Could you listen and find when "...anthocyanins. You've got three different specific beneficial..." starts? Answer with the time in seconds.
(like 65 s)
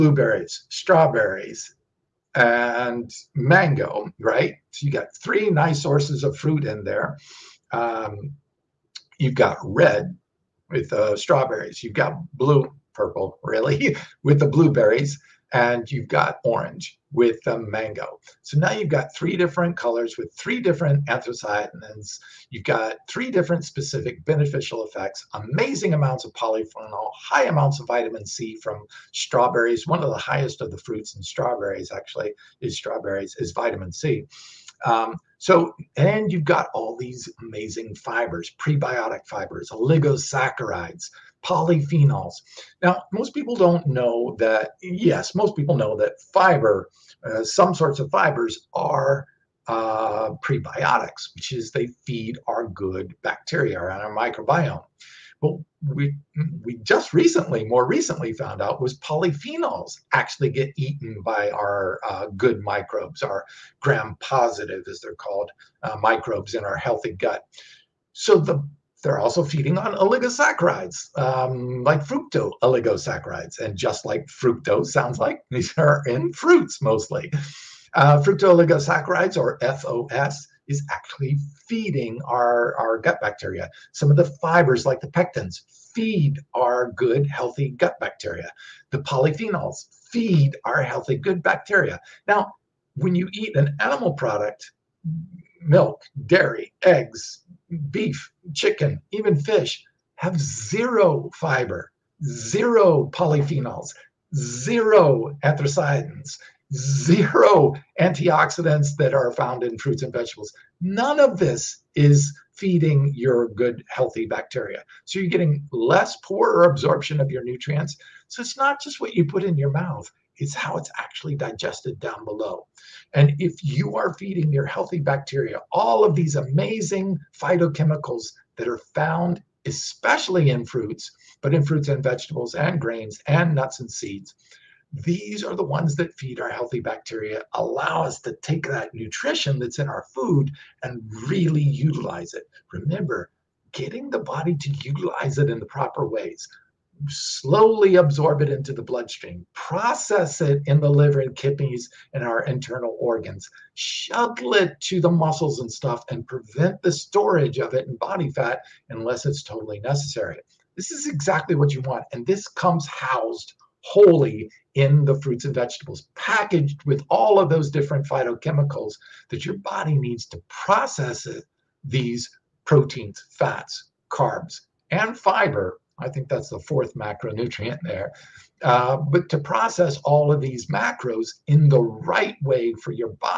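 21 s.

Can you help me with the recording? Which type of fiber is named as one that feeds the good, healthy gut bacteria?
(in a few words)
pectins.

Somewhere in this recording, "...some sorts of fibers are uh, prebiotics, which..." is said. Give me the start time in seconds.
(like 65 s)
47 s.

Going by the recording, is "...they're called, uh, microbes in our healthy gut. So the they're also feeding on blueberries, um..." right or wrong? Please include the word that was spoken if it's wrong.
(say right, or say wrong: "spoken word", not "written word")
wrong: "oligosaccharides", not "blueberries".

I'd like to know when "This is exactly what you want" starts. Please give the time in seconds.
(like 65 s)
160 s.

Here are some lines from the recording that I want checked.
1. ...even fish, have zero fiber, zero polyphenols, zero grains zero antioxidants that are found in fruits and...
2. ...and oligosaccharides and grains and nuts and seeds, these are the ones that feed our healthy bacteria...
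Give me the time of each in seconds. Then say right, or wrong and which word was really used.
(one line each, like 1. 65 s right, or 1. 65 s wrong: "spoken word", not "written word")
1. 99 s wrong: "anthocyanins", not "grains"
2. 131 s wrong: "vegetables", not "oligosaccharides".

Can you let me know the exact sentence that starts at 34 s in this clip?
Um, so, and you've got all these amazing fibers, prebiotic fibers, oligosaccharides, polyphenols.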